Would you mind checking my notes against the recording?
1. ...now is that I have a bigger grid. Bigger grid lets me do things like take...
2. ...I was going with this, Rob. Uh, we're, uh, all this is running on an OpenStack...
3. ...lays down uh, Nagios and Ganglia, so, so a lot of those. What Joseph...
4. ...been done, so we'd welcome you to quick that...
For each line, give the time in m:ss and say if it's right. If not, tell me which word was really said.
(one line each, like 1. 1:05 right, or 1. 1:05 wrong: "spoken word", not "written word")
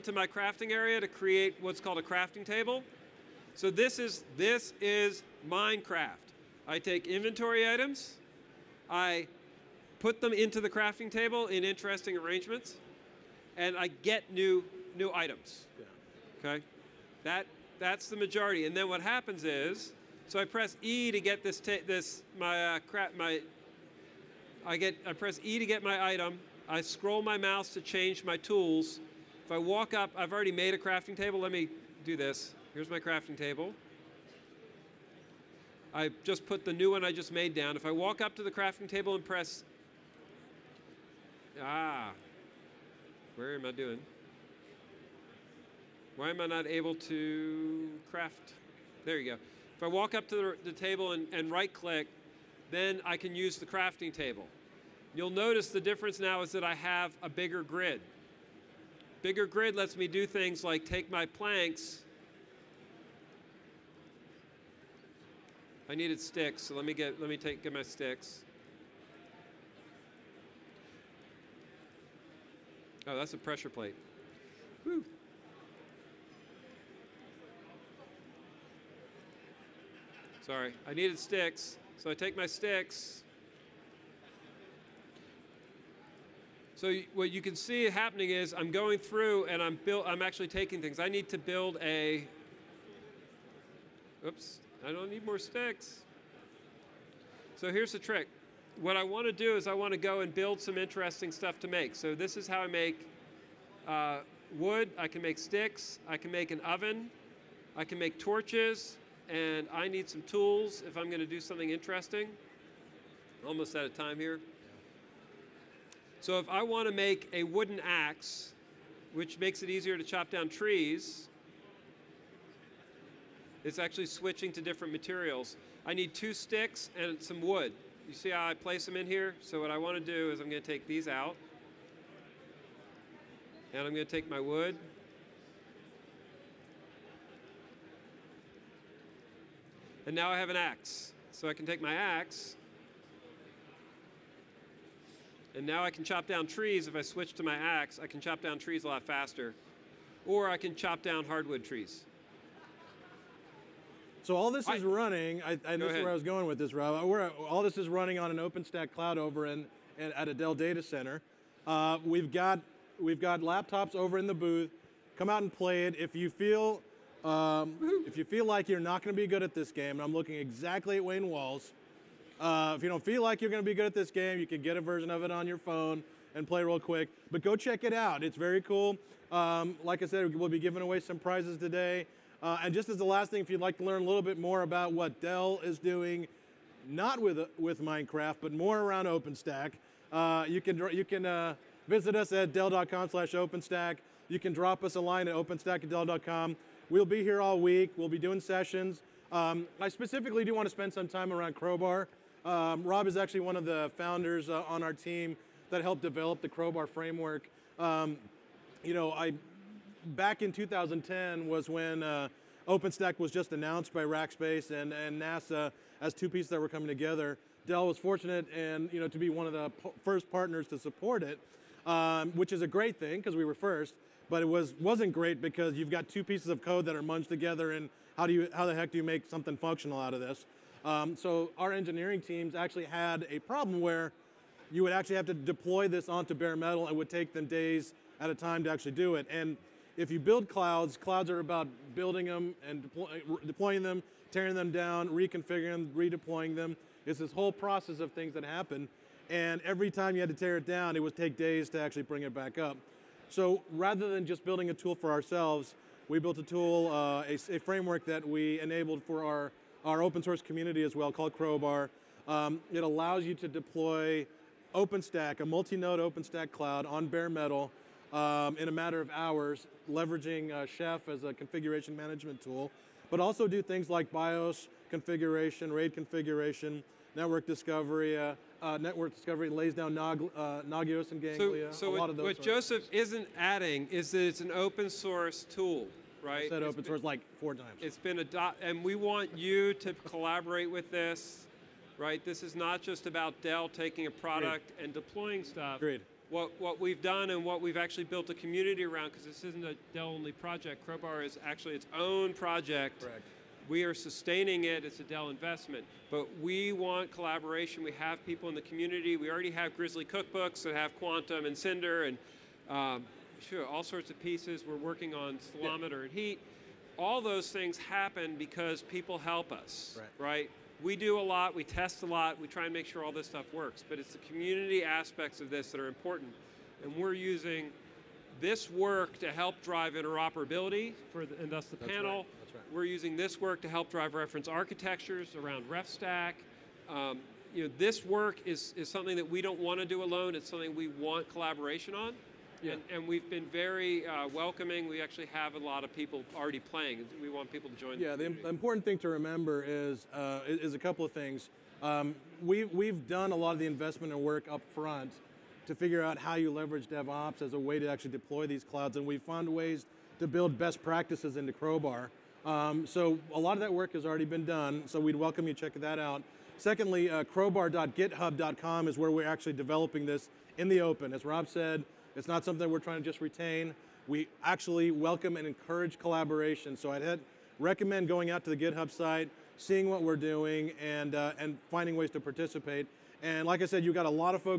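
1. 0:56 right
2. 2:36 right
3. 4:39 right
4. 6:04 wrong: "check", not "quick".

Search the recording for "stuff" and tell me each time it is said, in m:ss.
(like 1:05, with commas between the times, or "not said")
1:41, 4:55, 5:23.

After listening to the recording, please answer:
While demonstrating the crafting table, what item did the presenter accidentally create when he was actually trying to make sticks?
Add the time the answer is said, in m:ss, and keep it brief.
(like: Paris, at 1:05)
pressure plate, at 1:13.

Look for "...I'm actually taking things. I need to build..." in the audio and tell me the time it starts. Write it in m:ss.
1:30.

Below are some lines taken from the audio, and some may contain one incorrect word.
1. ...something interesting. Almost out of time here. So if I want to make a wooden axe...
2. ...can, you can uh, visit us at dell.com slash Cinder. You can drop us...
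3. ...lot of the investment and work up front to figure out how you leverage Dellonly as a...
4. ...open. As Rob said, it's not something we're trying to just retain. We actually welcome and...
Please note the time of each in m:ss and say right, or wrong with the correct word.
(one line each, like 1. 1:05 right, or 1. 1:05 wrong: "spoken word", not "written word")
1. 1:51 right
2. 3:10 wrong: "OpenStack", not "Cinder"
3. 5:53 wrong: "DevOps", not "Dellonly"
4. 6:10 right.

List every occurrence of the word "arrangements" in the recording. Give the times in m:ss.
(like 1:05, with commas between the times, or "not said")
0:12.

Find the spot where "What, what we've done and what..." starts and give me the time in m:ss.
4:56.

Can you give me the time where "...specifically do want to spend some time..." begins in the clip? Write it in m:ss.
3:19.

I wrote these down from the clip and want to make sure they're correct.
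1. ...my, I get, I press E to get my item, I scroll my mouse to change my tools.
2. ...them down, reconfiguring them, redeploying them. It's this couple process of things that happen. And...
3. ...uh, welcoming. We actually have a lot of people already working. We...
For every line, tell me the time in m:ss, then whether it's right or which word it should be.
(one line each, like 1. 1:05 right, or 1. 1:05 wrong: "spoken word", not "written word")
1. 0:23 right
2. 4:04 wrong: "whole", not "couple"
3. 5:44 wrong: "playing", not "working".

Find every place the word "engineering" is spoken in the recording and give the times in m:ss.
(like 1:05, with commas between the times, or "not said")
3:51.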